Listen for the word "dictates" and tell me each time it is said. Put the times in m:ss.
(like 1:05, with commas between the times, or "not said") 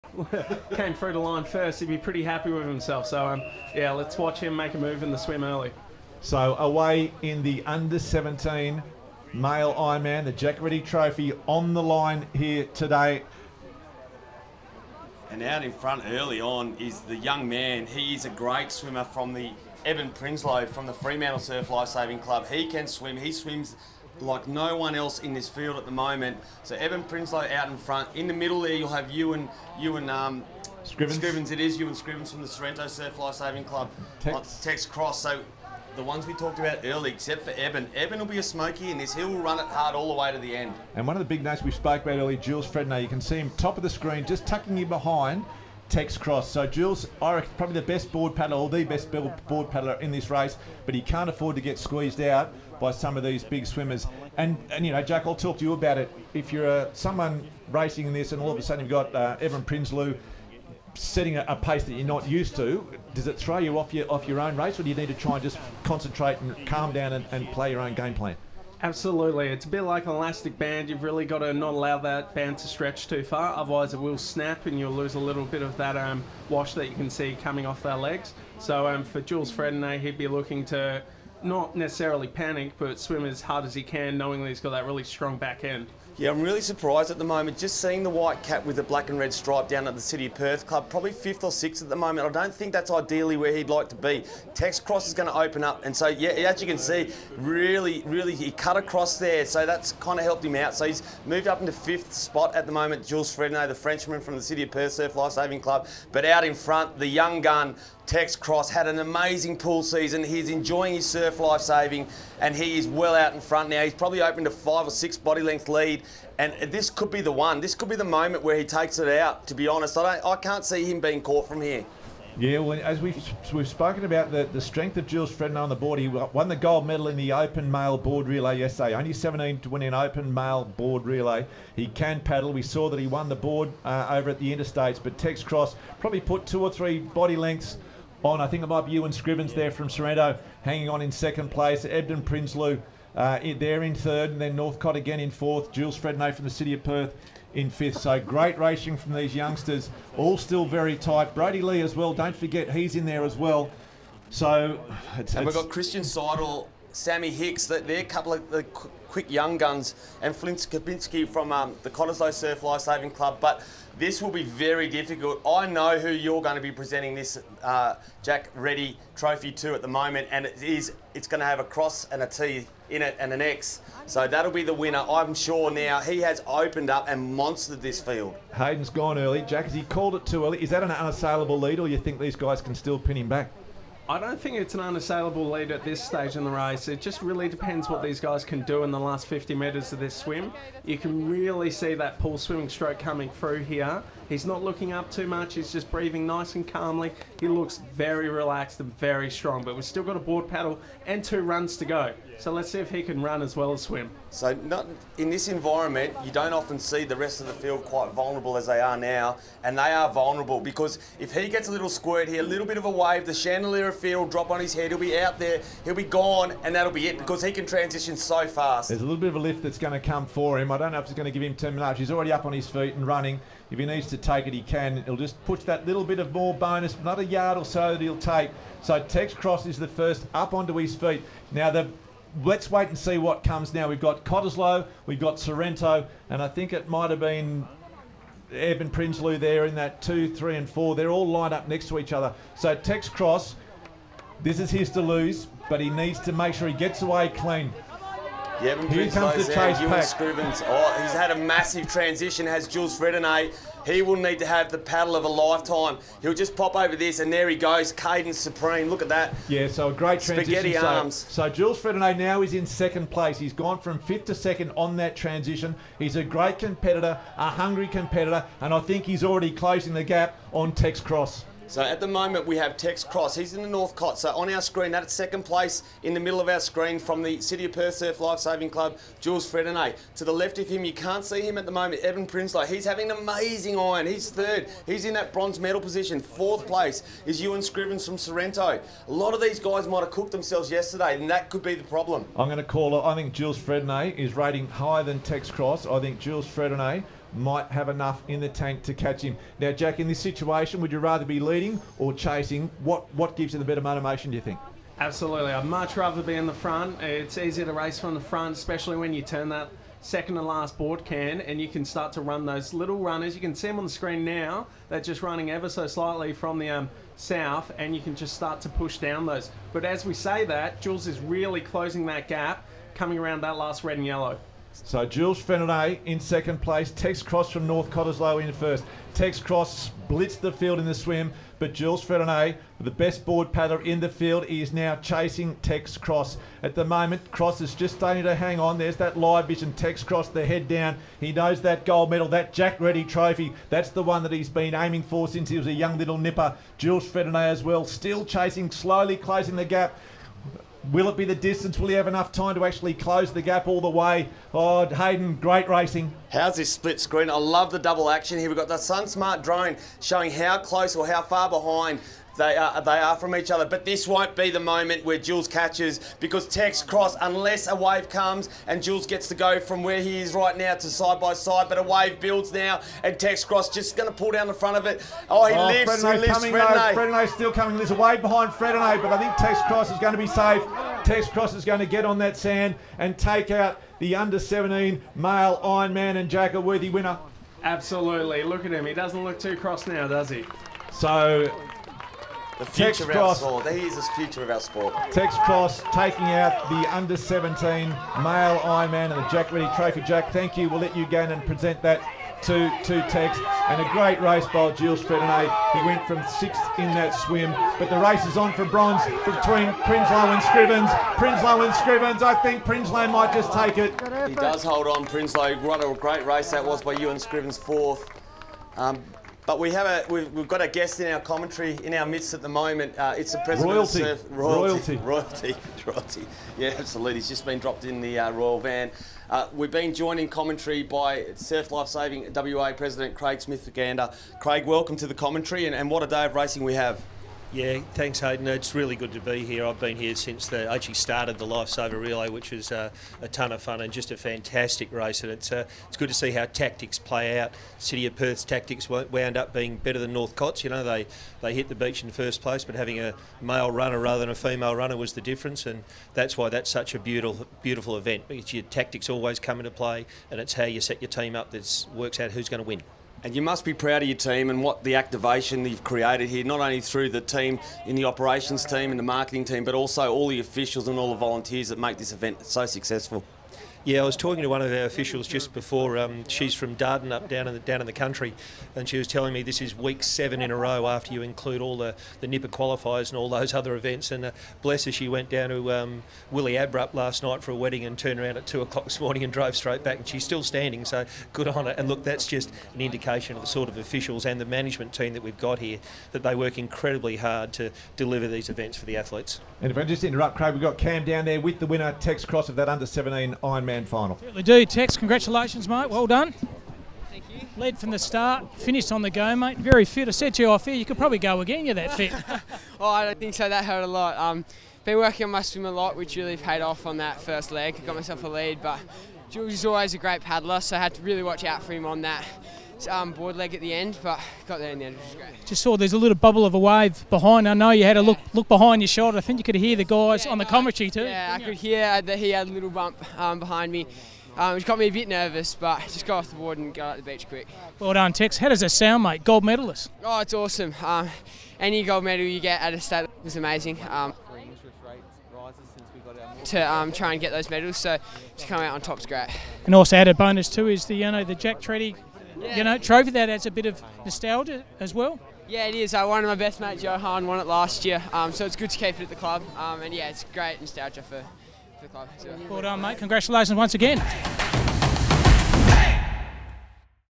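not said.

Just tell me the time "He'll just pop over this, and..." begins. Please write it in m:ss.
4:16.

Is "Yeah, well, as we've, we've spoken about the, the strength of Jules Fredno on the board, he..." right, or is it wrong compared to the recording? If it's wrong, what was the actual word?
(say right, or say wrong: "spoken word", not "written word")
right.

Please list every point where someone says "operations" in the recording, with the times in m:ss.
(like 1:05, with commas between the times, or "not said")
7:48.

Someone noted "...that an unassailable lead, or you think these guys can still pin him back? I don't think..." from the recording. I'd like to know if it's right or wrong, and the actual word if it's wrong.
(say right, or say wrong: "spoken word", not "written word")
right.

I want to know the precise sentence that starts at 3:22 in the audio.
So let's see if he can run as well as swim.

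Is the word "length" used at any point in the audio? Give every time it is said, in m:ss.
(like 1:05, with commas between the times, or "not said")
1:55, 2:17.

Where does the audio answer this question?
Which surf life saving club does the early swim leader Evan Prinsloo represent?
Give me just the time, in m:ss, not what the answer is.
0:20.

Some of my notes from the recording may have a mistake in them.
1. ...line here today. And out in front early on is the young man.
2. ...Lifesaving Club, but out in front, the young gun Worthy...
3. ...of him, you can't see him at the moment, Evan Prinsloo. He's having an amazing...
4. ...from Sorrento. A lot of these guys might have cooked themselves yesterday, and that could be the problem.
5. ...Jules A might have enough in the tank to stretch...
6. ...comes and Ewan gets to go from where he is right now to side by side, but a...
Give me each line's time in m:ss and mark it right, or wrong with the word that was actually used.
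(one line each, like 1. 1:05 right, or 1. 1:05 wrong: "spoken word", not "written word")
1. 0:11 right
2. 1:45 wrong: "Tex", not "Worthy"
3. 4:40 right
4. 4:48 right
5. 4:56 wrong: "catch", not "stretch"
6. 6:08 wrong: "Jules", not "Ewan".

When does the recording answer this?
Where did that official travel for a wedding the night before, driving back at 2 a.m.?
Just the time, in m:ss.
8:06.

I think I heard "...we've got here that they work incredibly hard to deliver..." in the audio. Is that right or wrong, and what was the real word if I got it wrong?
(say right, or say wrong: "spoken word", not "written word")
right.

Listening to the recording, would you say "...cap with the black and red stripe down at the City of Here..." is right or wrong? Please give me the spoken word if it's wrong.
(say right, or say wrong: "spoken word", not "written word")
wrong: "Perth", not "Here".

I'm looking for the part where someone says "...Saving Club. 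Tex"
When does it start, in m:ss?
0:33.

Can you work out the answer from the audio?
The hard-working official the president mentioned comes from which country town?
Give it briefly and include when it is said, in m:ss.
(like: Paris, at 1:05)
Dardanup, at 7:56.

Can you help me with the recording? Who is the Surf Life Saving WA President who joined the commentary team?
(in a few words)
Craig Smith Gander.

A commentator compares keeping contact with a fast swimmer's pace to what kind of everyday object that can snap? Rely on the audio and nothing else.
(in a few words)
Elastic band.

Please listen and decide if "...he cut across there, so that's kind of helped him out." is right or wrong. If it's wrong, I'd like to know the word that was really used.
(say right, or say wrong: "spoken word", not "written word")
right.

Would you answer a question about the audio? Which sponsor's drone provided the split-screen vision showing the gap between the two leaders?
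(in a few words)
Sun Smart.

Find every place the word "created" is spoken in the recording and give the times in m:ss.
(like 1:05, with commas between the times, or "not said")
7:45.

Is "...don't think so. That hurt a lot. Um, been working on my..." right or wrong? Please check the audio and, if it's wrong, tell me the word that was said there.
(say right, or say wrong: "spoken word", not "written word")
right.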